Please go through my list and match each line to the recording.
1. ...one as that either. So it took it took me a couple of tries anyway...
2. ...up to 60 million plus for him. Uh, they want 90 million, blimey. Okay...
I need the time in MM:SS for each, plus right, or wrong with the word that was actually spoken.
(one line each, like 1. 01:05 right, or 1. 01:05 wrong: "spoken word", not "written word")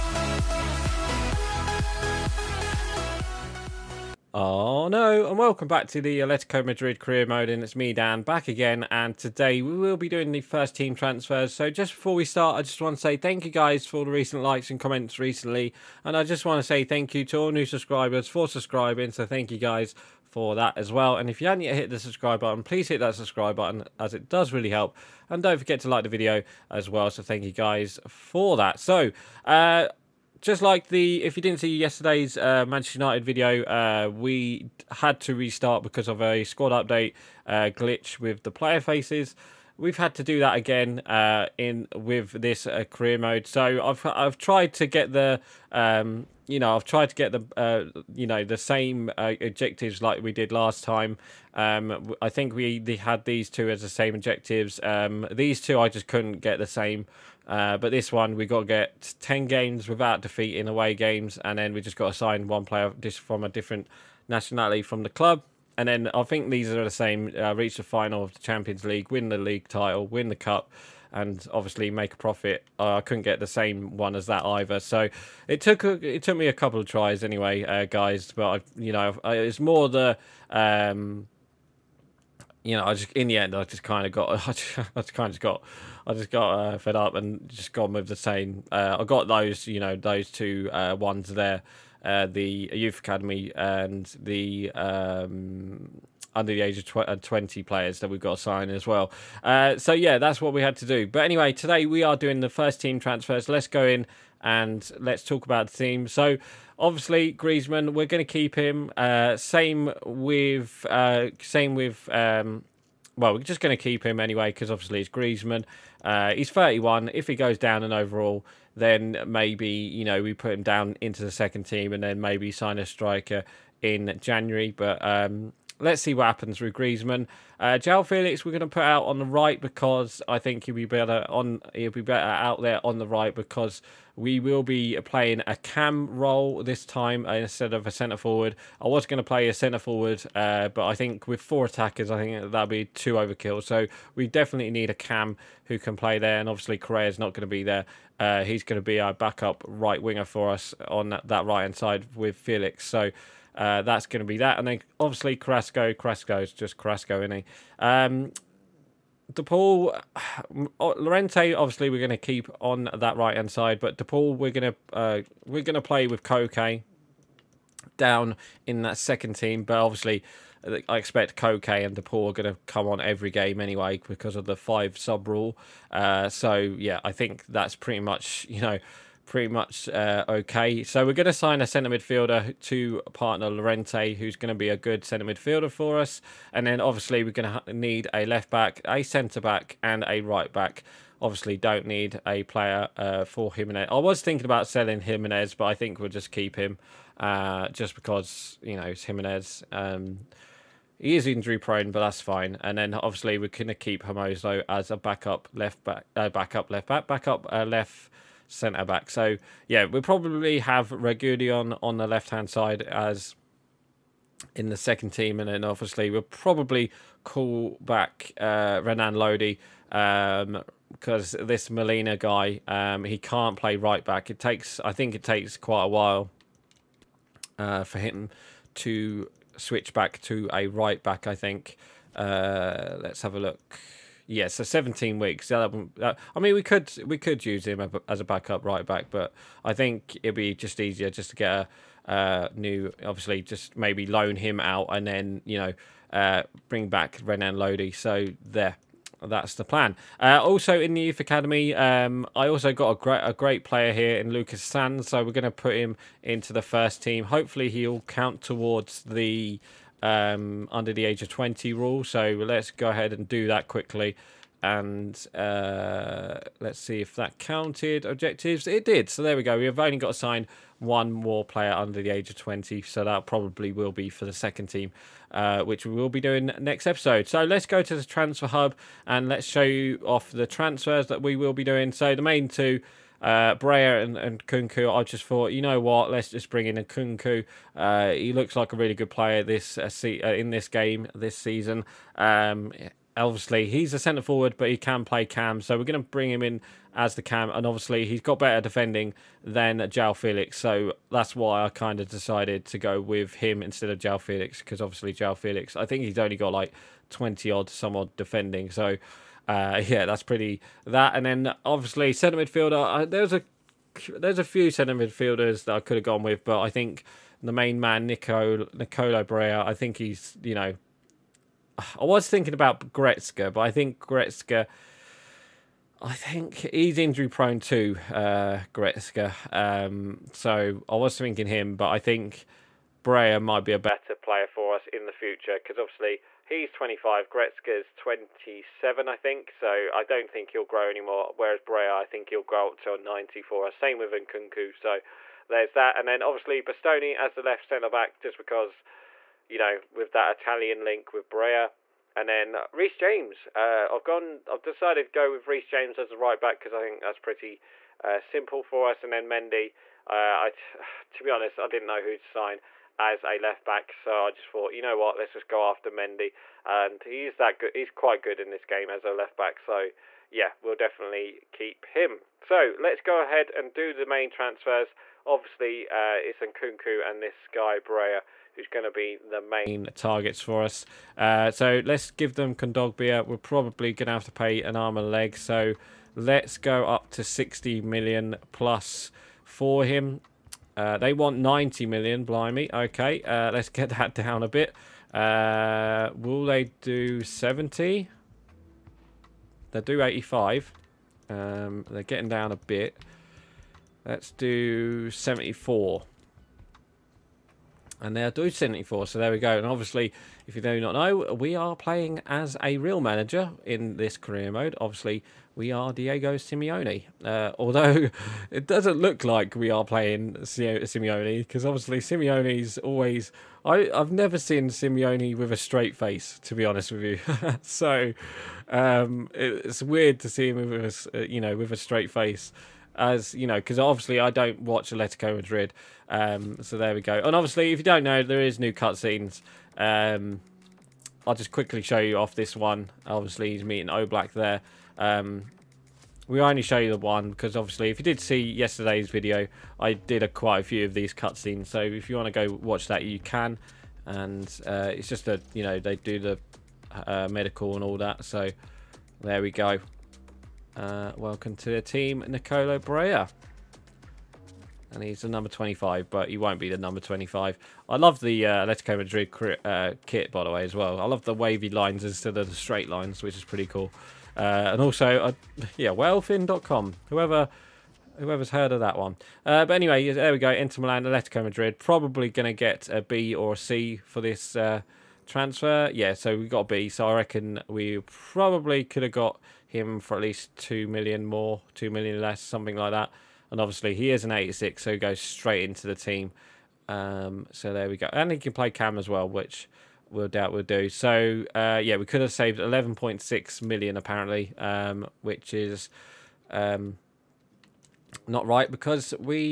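1. 01:13 right
2. 06:26 right.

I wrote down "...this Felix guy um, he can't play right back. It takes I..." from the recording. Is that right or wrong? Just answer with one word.
wrong.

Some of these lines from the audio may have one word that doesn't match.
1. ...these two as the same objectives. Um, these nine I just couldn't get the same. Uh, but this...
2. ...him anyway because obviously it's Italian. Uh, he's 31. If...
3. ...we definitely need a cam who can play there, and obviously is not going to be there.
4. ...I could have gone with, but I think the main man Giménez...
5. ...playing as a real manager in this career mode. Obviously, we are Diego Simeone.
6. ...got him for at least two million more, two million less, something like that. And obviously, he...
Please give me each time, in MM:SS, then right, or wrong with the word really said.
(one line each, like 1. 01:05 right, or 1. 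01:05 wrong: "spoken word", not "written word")
1. 00:53 wrong: "two", not "nine"
2. 01:54 wrong: "Griezmann", not "Italian"
3. 02:24 right
4. 05:15 wrong: "Nico", not "Giménez"
5. 06:51 right
6. 08:09 right.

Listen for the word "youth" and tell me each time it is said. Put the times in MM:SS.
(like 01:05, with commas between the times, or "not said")
01:32, 04:11.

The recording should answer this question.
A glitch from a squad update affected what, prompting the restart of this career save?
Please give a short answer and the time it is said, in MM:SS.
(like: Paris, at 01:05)
Player faces, at 00:38.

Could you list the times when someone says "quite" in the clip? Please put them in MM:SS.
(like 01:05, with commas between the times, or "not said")
03:45, 06:07, 07:30.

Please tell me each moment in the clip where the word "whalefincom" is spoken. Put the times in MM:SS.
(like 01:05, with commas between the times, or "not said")
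07:55.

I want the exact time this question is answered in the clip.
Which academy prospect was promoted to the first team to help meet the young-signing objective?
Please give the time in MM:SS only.
04:14.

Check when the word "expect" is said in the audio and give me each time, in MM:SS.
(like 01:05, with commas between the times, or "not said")
02:50.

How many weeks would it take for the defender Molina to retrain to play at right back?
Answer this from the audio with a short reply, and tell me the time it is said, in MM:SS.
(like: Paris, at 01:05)
17, at 03:54.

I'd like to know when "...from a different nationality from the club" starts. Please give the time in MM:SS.
01:03.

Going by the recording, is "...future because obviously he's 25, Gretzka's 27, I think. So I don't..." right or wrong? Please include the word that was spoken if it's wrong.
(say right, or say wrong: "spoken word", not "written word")
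right.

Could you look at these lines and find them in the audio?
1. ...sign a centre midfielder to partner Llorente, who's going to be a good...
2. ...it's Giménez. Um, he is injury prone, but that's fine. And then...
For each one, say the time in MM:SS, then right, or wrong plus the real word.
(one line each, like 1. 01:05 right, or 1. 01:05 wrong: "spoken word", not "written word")
1. 03:01 right
2. 03:18 right.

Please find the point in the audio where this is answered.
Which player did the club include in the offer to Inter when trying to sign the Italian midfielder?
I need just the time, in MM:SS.
06:22.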